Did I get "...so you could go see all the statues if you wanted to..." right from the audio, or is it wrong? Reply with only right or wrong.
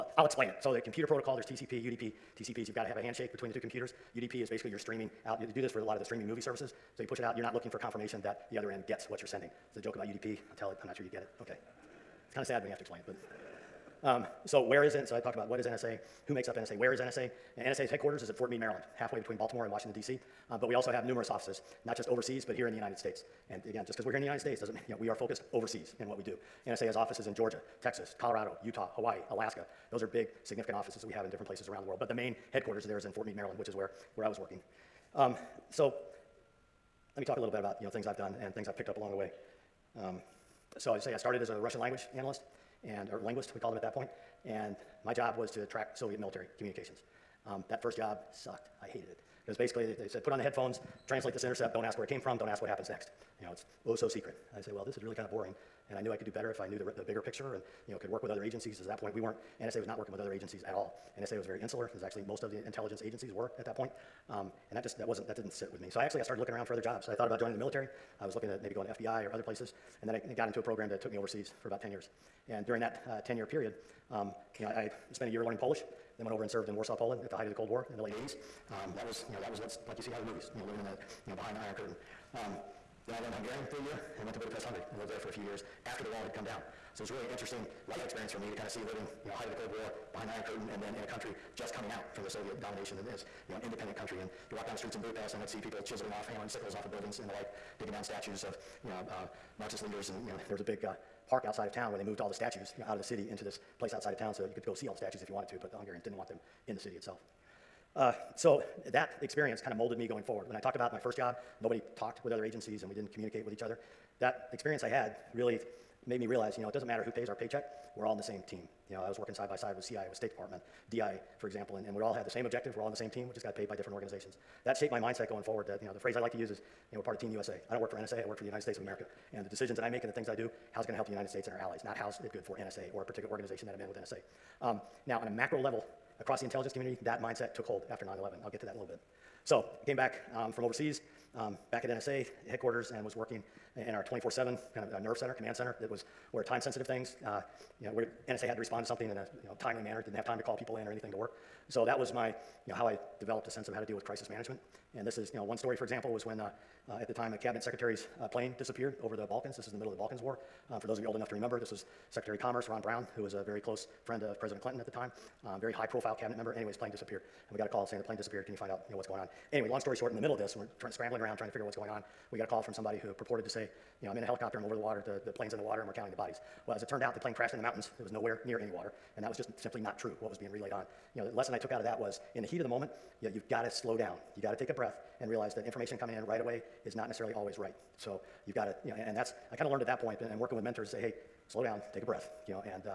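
right.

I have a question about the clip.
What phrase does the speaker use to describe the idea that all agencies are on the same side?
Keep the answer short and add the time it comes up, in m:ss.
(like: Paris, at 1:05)
Team USA, at 2:07.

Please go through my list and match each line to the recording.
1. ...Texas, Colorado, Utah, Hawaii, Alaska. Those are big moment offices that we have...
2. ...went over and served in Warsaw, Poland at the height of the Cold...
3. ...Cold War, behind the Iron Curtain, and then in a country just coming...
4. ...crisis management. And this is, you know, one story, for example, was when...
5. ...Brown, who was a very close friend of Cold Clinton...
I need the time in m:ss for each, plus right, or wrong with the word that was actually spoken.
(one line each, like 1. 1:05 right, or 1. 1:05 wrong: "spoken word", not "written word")
1. 0:27 wrong: "significant", not "moment"
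2. 1:16 right
3. 1:29 right
4. 2:34 right
5. 2:42 wrong: "President", not "Cold".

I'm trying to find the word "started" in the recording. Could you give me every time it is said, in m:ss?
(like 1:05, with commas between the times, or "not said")
0:41, 1:06.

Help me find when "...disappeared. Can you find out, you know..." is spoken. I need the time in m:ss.
2:48.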